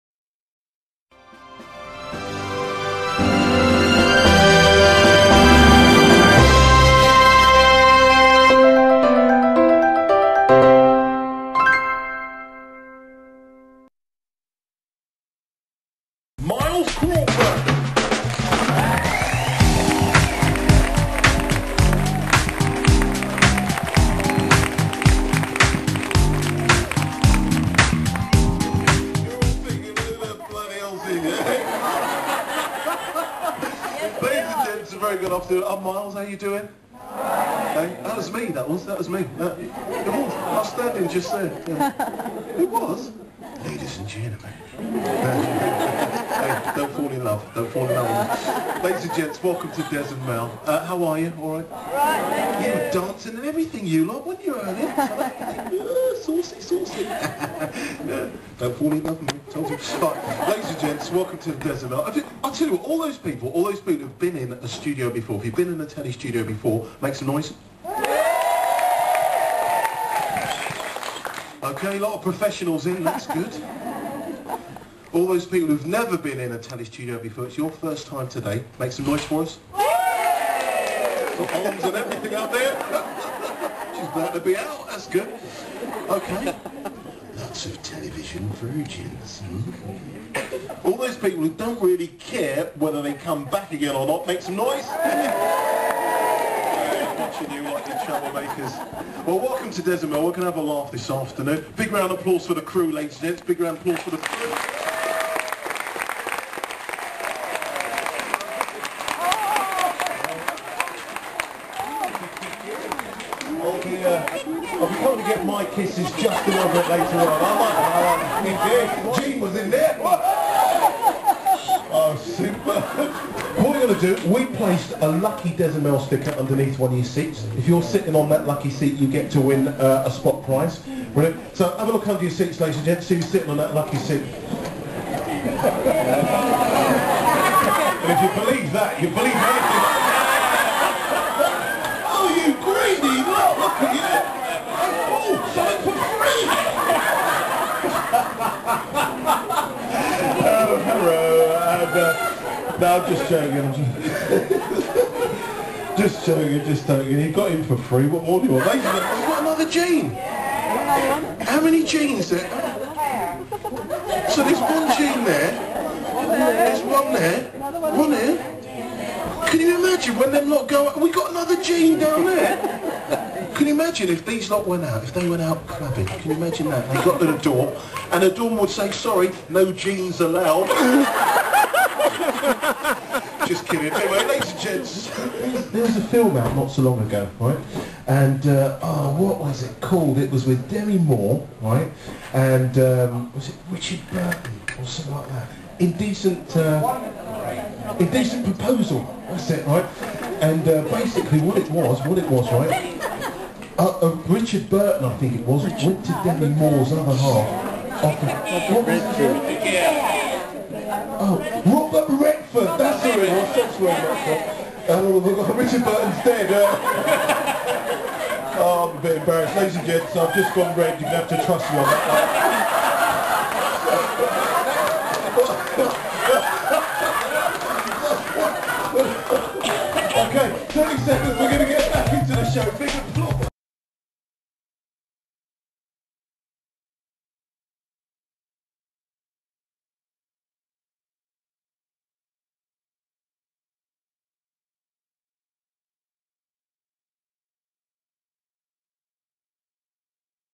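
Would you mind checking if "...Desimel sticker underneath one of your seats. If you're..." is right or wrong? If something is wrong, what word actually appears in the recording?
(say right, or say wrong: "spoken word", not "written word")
right.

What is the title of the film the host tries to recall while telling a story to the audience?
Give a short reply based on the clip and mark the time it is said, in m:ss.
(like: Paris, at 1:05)
Indecent Proposal, at 3:17.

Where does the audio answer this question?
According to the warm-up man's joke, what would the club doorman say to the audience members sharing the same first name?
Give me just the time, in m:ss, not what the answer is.
2:59.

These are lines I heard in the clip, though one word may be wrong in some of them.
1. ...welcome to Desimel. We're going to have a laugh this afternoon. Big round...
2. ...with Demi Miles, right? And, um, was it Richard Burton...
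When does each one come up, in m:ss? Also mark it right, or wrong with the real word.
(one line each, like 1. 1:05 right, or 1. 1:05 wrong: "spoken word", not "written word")
1. 1:39 right
2. 3:10 wrong: "Moore", not "Miles".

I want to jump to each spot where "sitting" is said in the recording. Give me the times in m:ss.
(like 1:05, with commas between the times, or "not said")
2:07, 2:13.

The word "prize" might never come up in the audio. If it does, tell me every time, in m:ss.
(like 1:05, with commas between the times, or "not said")
2:10.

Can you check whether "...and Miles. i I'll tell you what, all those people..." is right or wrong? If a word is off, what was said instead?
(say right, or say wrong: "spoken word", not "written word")
wrong: "Mel", not "Miles".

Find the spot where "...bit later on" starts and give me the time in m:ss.
1:56.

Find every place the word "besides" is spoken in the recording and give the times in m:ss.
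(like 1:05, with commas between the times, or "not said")
not said.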